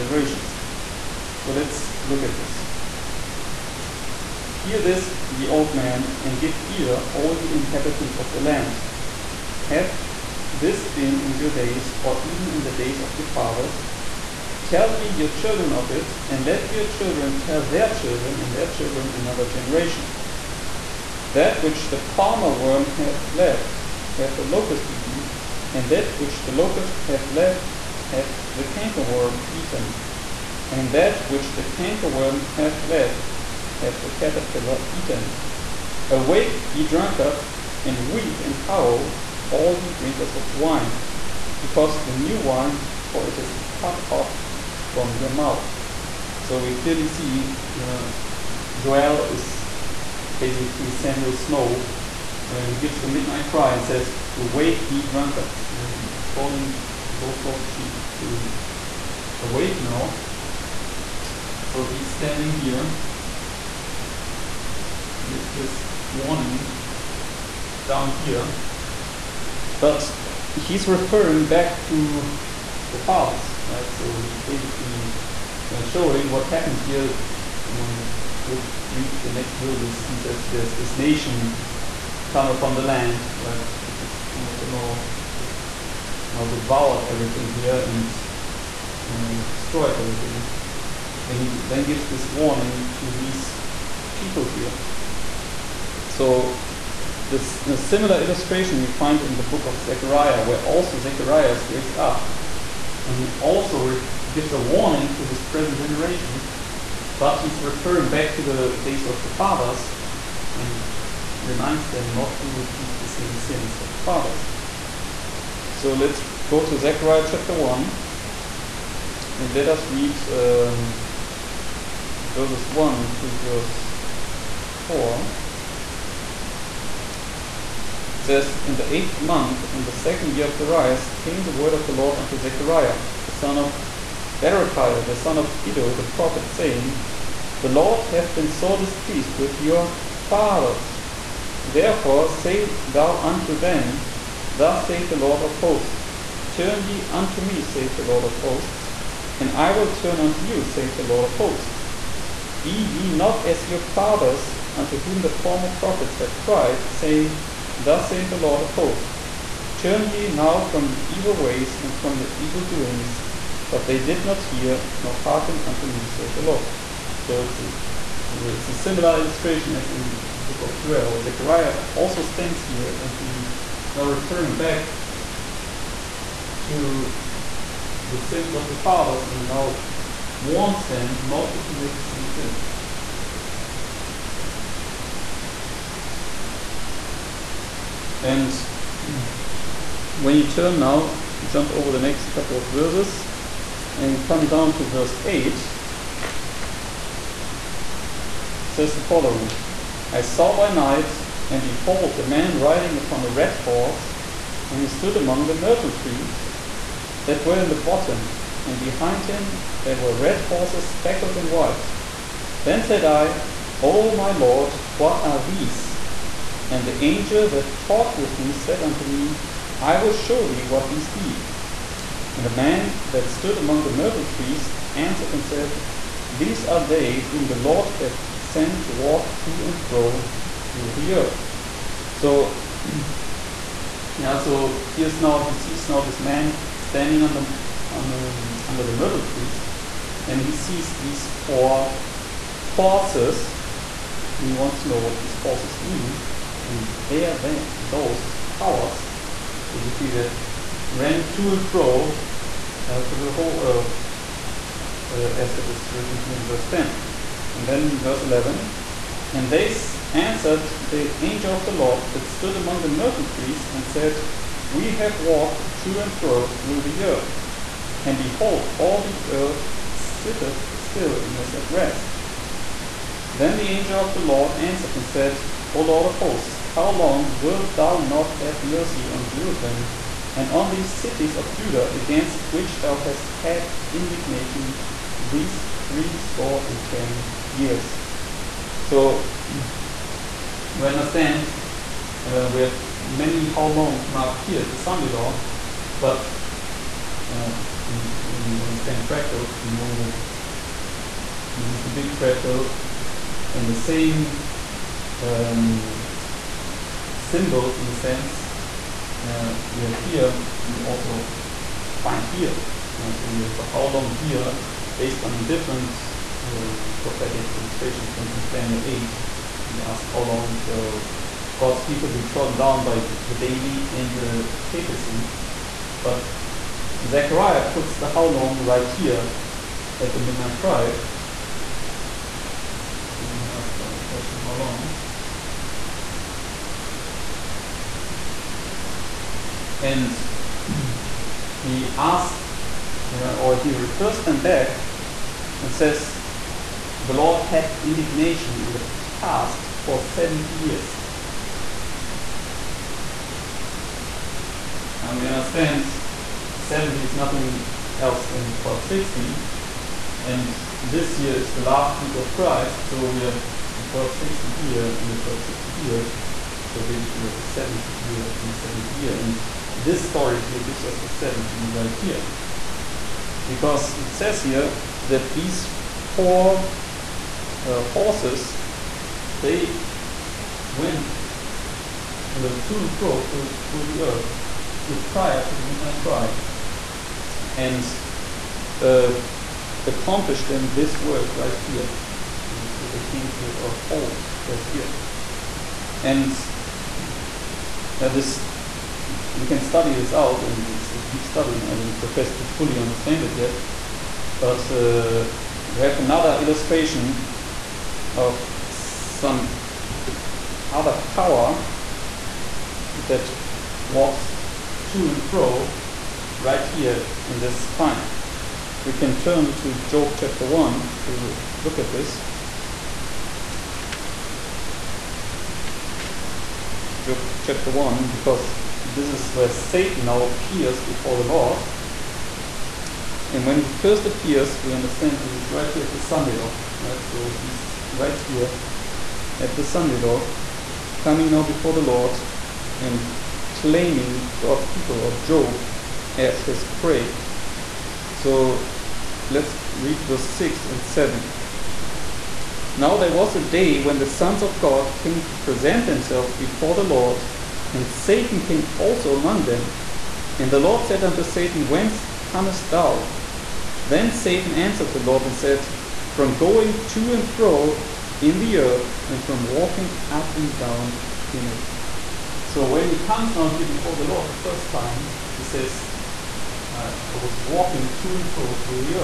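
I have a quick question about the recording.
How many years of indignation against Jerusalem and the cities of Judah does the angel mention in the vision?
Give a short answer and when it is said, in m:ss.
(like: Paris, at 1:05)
70, at 4:45.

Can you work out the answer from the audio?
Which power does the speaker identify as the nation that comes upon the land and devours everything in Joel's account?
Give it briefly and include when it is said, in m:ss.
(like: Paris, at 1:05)
king of the north, at 1:24.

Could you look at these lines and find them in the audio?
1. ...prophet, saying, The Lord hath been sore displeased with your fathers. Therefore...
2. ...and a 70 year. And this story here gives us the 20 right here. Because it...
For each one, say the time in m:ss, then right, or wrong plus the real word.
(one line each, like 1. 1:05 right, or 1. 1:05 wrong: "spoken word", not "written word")
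1. 2:16 right
2. 6:08 wrong: "70", not "20".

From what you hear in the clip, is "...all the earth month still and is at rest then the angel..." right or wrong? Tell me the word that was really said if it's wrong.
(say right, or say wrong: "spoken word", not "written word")
wrong: "sitteth", not "month".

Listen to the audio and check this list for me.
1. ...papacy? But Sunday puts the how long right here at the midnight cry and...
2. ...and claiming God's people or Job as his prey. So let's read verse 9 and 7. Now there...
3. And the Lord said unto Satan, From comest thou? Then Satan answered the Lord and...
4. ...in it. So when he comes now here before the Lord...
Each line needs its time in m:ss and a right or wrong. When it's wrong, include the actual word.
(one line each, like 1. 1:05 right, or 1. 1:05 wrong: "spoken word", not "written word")
1. 5:24 wrong: "Zechariah", not "Sunday"
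2. 7:22 wrong: "6", not "9"
3. 7:40 wrong: "Whence", not "From"
4. 7:51 right.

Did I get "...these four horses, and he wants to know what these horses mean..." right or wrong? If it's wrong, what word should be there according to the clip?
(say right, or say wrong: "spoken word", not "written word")
right.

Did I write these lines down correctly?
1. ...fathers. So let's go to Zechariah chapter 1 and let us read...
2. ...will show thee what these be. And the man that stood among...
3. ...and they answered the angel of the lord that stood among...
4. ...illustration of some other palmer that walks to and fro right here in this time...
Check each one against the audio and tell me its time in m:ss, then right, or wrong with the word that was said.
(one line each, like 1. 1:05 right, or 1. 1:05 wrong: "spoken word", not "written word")
1. 1:53 right
2. 3:40 right
3. 4:19 right
4. 6:46 wrong: "power", not "palmer".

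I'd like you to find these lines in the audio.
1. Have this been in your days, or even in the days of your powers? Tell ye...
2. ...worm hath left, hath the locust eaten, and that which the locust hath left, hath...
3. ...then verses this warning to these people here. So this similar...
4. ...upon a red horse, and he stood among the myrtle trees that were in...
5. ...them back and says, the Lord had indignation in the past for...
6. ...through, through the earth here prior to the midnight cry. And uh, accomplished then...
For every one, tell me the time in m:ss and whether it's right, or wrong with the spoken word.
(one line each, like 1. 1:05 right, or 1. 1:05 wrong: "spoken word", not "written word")
1. 0:09 wrong: "fathers", not "powers"
2. 0:22 right
3. 1:31 wrong: "gives", not "verses"
4. 3:22 right
5. 5:44 right
6. 6:23 right.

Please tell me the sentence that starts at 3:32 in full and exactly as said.
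Then said I, O my Lord, what are these?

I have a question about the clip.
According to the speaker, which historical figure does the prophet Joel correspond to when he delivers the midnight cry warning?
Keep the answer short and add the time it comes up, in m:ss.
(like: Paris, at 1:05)
Samuel Snow, at 0:50.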